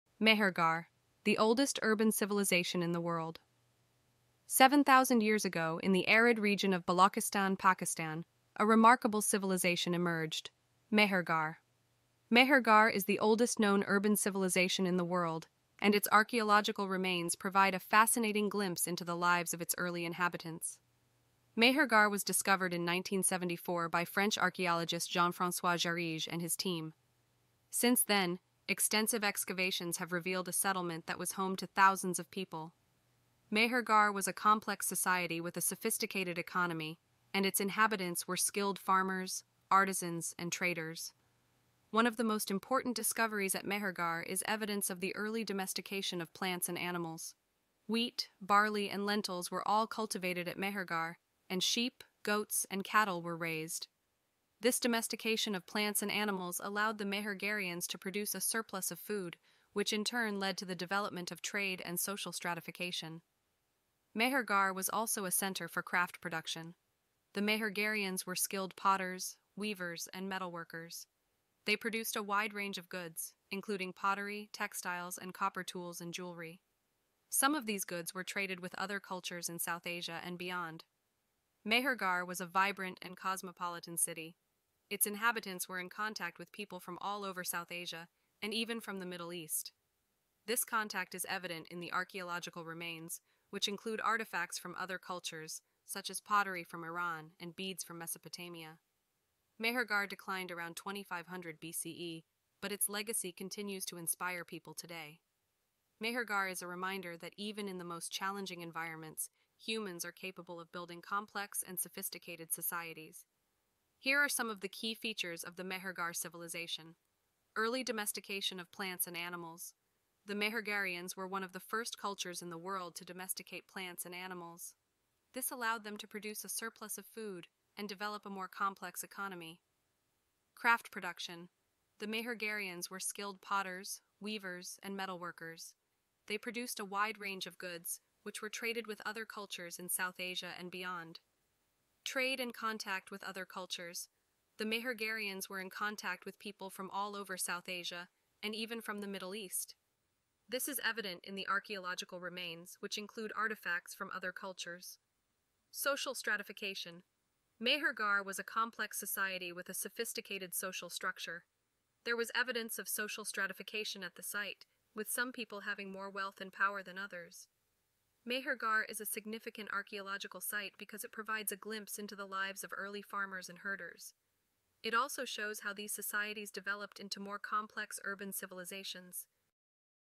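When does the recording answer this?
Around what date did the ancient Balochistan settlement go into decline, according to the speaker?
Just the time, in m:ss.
1:40.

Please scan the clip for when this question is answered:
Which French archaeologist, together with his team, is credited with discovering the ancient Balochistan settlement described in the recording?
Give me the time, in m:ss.
0:25.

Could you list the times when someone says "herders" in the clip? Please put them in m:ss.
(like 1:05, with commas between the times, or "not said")
2:53.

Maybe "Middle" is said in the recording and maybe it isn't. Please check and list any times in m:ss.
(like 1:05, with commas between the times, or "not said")
1:29, 2:29.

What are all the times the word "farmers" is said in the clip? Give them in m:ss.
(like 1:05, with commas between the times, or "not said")
0:38, 2:53.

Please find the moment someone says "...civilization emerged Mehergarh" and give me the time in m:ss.
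0:09.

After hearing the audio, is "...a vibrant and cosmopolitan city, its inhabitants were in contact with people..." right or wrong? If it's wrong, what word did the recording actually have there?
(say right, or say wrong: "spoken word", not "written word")
right.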